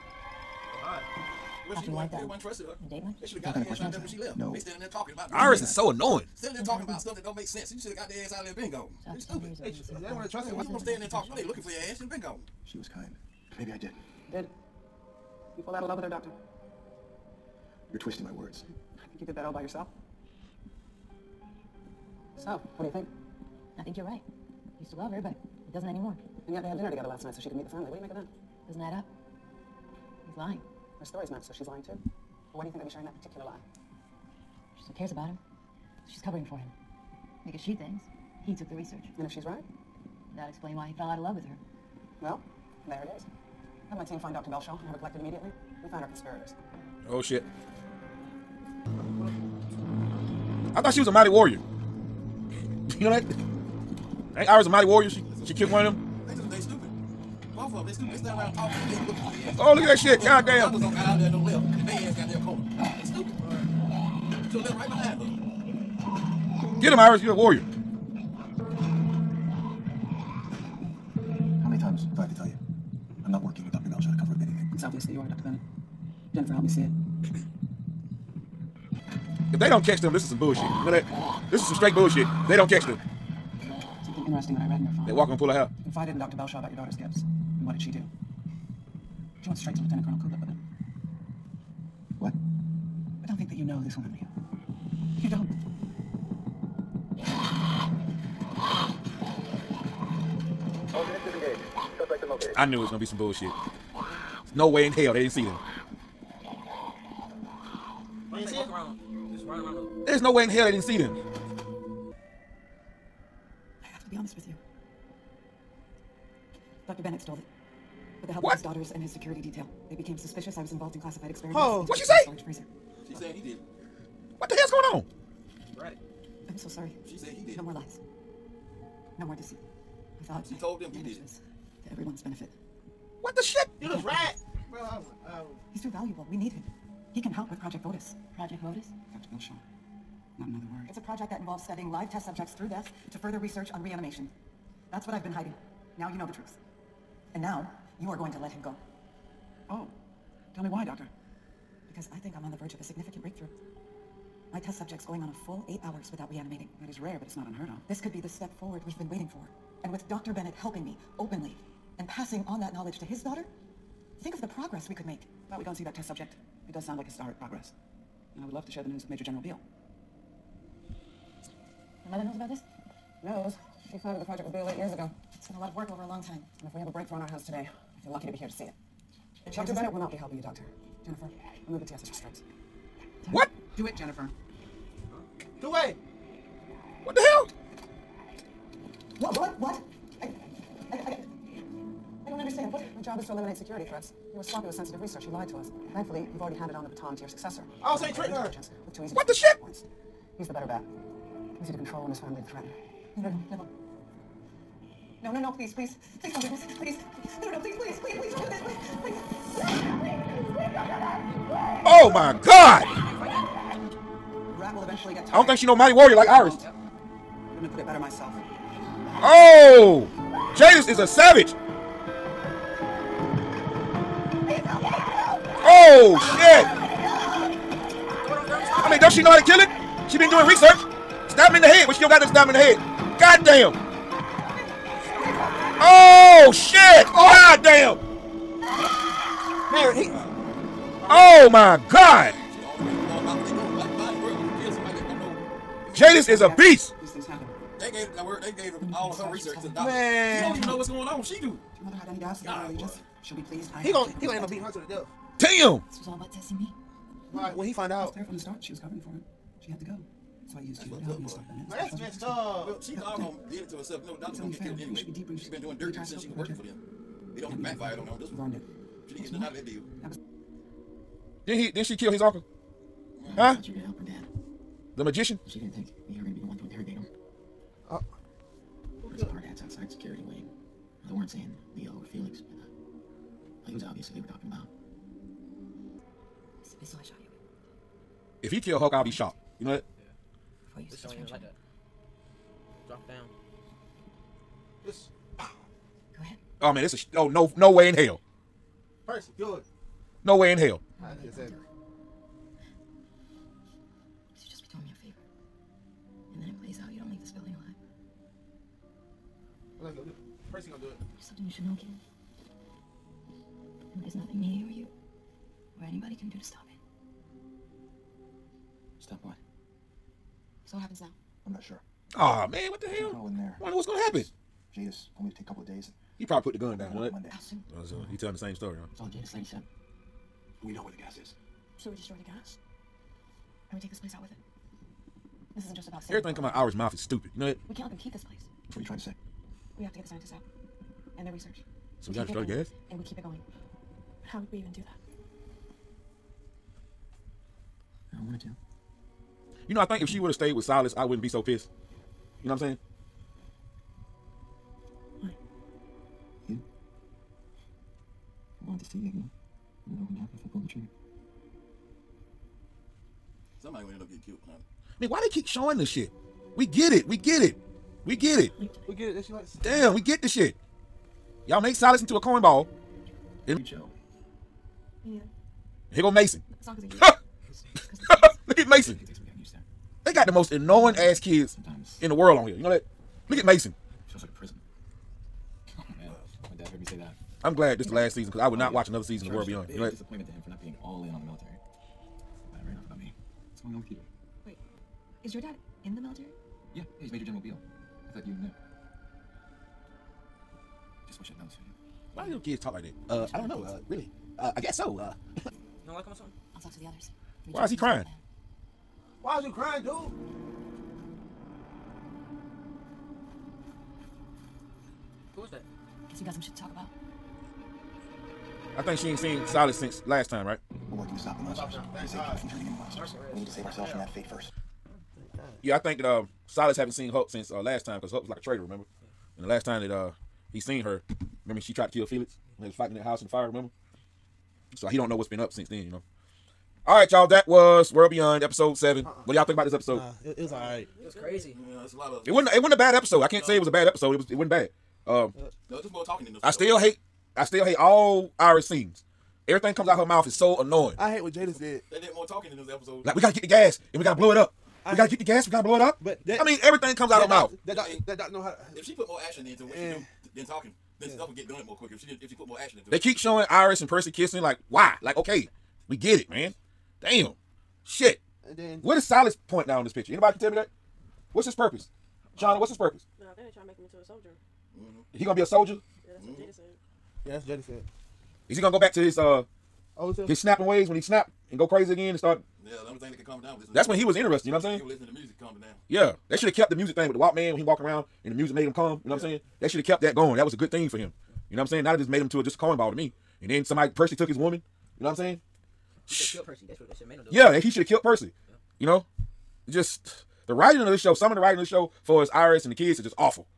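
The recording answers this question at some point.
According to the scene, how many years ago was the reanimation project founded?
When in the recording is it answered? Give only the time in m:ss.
2:54.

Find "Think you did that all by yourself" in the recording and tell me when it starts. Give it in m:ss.
0:19.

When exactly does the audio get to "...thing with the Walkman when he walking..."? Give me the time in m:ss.
8:06.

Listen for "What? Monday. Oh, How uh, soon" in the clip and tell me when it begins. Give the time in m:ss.
5:26.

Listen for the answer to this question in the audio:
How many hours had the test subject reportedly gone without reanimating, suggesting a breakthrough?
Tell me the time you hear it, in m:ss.
2:35.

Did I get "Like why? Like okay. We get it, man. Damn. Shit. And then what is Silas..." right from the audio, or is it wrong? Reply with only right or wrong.
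right.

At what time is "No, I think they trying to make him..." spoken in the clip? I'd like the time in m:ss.
7:53.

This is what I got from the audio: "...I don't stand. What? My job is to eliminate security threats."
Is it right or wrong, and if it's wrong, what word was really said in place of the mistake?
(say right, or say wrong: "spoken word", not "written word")
wrong: "understand", not "stand".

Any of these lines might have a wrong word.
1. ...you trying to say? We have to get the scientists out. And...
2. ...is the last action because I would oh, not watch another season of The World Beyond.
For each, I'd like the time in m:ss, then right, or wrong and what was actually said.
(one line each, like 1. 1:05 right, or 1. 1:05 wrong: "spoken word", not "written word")
1. 5:38 right
2. 6:27 wrong: "season", not "action".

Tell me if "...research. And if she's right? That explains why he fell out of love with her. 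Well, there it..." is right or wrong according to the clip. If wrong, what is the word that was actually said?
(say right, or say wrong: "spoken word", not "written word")
right.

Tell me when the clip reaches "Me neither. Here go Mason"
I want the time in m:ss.
6:15.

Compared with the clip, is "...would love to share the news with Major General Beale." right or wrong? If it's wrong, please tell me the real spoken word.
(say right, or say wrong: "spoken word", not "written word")
right.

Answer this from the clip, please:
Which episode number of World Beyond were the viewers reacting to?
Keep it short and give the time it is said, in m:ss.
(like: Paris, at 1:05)
7, at 7:18.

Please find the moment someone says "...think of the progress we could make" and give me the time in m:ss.
2:44.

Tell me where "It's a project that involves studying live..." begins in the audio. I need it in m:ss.
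2:20.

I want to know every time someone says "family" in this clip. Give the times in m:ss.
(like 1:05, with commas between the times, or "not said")
0:27, 3:22.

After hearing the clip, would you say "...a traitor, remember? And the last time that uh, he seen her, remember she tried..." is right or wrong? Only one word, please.
right.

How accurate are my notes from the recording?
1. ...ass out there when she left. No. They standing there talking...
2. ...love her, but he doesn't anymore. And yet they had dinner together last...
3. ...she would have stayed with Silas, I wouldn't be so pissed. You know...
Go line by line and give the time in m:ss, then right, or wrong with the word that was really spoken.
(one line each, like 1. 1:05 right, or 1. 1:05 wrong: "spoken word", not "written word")
1. 0:03 right
2. 0:24 right
3. 5:50 right.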